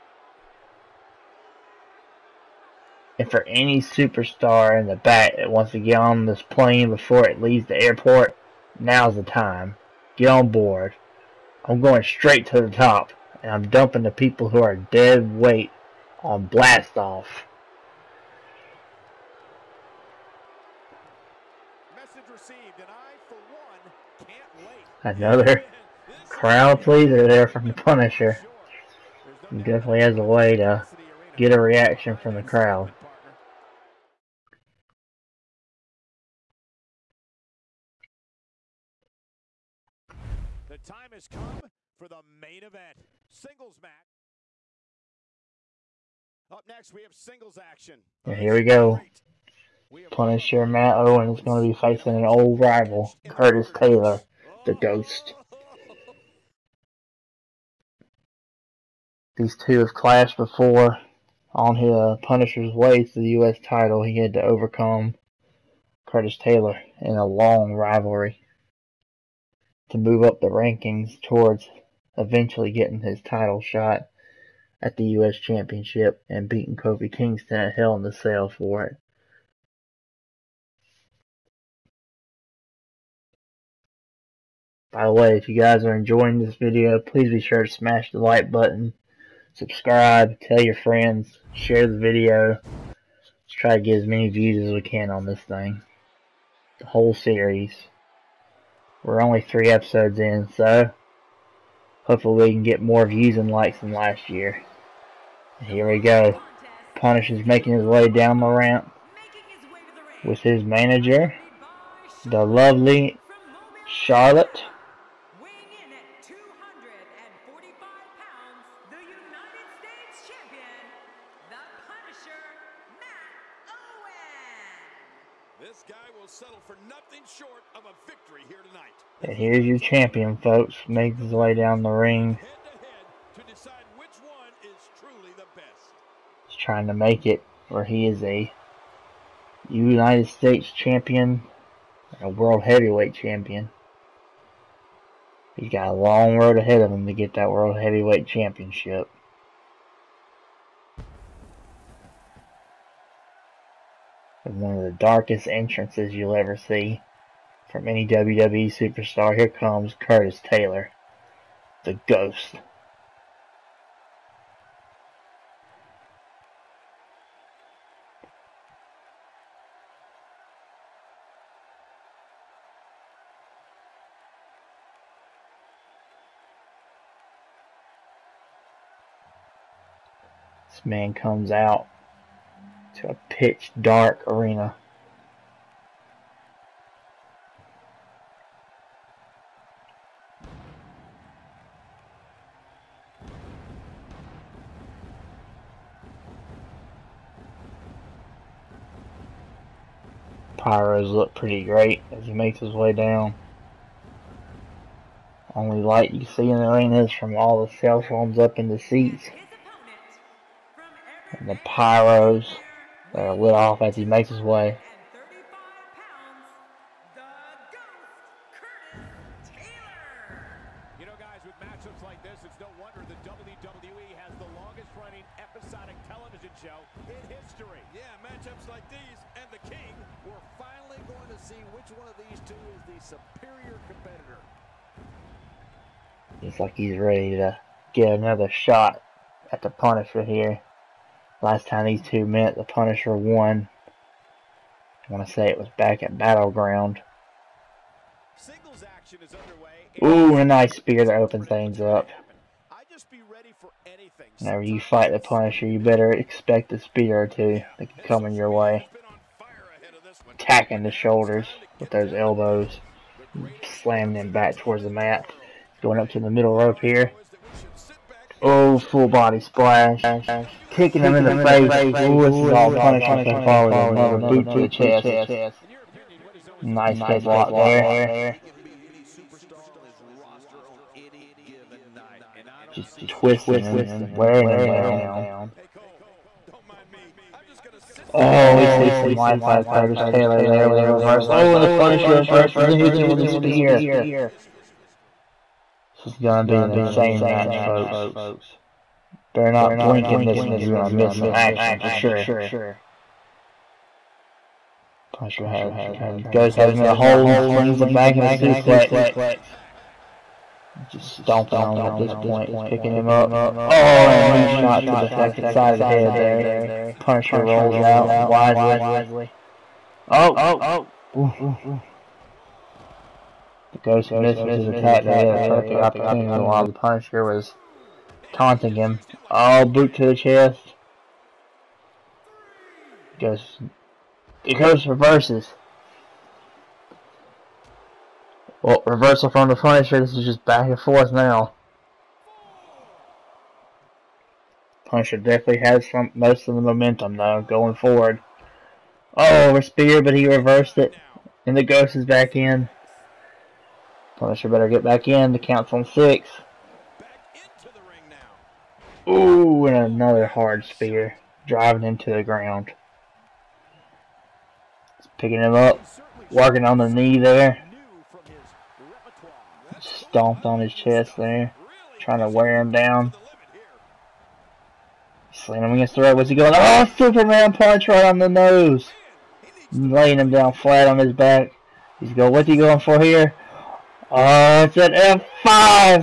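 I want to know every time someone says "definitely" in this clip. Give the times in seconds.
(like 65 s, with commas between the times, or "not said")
29 s, 345 s.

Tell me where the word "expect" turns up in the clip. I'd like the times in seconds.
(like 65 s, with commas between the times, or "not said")
256 s.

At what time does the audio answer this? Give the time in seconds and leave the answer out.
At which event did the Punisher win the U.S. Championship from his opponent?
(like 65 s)
77 s.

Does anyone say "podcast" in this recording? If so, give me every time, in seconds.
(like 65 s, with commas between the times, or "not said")
not said.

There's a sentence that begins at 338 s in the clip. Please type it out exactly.
Well, reversal from the Punisher, this is just back and forth now.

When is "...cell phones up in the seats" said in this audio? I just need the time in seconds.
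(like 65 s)
207 s.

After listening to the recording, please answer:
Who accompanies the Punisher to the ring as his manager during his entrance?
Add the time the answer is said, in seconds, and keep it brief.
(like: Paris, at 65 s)
Charlotte, at 113 s.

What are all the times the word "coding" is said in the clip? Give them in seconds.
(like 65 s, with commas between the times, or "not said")
not said.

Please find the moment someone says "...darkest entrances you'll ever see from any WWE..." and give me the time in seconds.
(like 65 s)
154 s.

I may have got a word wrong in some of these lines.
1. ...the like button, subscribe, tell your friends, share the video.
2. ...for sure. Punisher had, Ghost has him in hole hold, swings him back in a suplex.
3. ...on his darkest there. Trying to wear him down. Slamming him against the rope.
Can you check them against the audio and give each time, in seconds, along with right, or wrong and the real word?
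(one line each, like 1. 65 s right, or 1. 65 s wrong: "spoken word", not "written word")
1. 88 s right
2. 301 s right
3. 370 s wrong: "chest", not "darkest".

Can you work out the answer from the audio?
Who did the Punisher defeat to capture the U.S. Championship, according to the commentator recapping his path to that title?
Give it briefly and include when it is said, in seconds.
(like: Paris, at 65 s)
Kofi Kingston, at 76 s.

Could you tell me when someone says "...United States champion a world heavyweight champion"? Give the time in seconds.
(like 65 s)
139 s.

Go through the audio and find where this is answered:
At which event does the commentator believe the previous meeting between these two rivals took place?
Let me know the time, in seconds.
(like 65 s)
246 s.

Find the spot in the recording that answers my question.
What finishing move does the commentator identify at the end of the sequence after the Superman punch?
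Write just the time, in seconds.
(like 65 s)
384 s.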